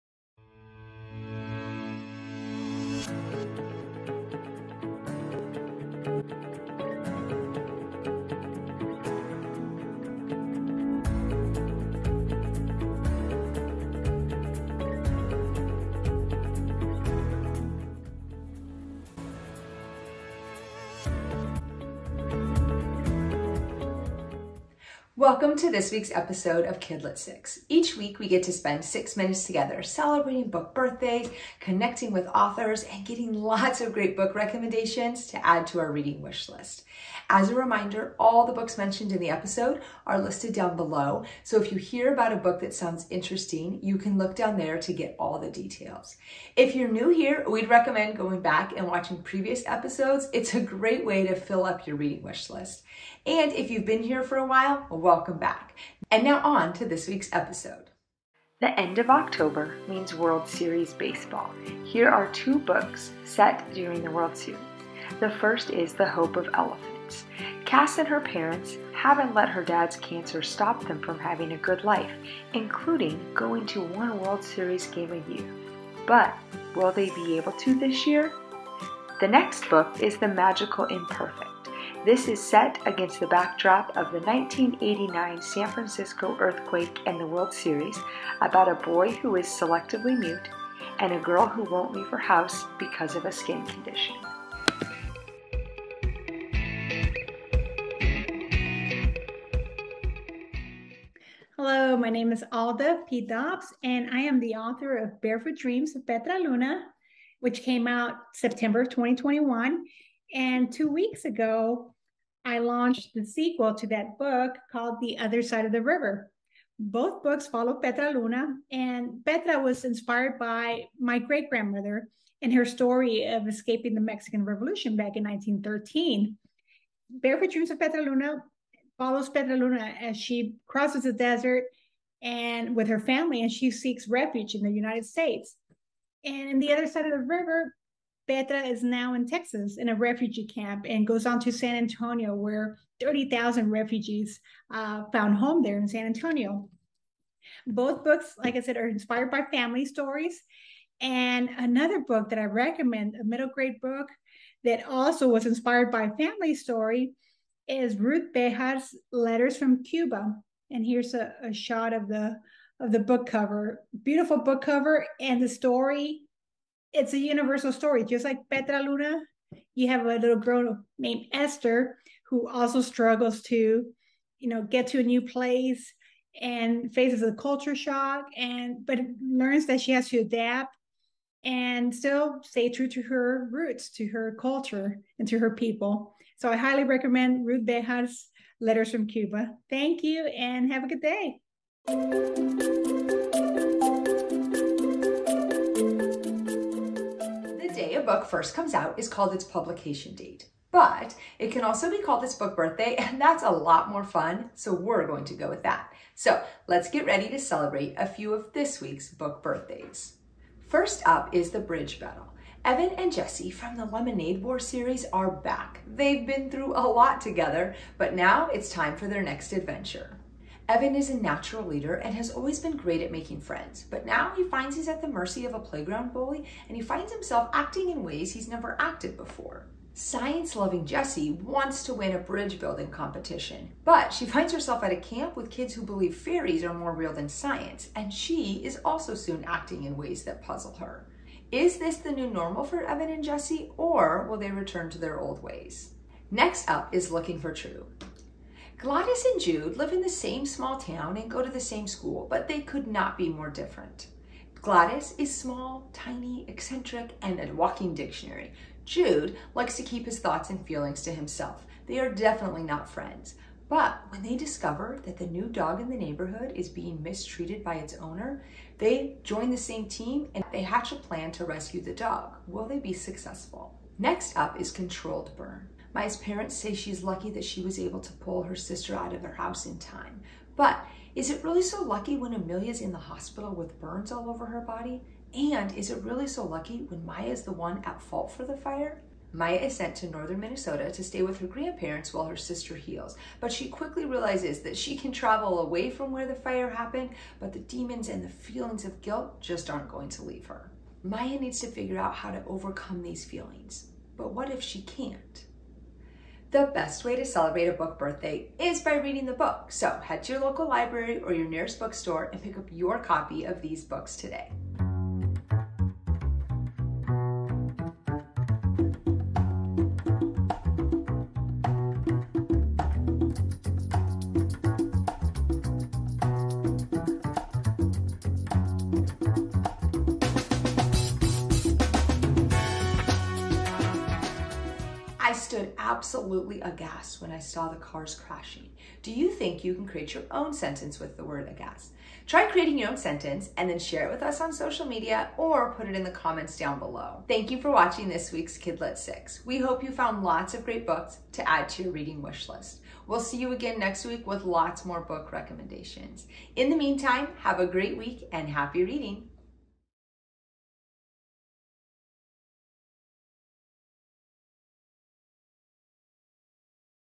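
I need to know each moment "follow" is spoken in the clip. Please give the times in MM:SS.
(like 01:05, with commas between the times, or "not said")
01:57, 02:08.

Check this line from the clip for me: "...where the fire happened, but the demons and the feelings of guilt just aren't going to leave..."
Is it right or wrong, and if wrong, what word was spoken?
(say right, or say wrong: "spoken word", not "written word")
right.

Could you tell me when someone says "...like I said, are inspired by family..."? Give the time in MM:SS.
02:28.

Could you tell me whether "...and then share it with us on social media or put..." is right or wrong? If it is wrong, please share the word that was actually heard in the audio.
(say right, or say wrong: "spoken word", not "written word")
right.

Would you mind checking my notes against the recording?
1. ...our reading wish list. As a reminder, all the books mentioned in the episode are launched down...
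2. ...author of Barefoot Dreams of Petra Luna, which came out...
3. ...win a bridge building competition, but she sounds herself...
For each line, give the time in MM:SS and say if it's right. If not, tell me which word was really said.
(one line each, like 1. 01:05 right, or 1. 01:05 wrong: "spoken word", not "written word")
1. 00:35 wrong: "listed", not "launched"
2. 01:44 right
3. 03:51 wrong: "finds", not "sounds".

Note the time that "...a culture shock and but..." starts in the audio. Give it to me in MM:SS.
02:57.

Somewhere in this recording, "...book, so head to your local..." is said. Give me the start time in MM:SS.
05:09.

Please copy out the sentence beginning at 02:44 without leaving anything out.
Beautiful book cover, and the story it's a universal story, just like Petra Luna.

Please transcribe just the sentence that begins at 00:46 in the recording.
If you're new here, we'd recommend going back and watching previous episodes.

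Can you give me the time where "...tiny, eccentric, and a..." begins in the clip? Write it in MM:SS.
04:15.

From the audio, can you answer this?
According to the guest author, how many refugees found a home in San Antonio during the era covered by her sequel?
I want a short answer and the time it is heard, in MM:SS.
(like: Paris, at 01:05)
30,000, at 02:23.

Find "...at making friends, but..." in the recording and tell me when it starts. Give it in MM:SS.
03:43.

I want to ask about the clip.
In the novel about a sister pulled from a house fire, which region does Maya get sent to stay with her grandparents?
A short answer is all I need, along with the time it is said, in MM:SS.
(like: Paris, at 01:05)
Northern Minnesota, at 04:50.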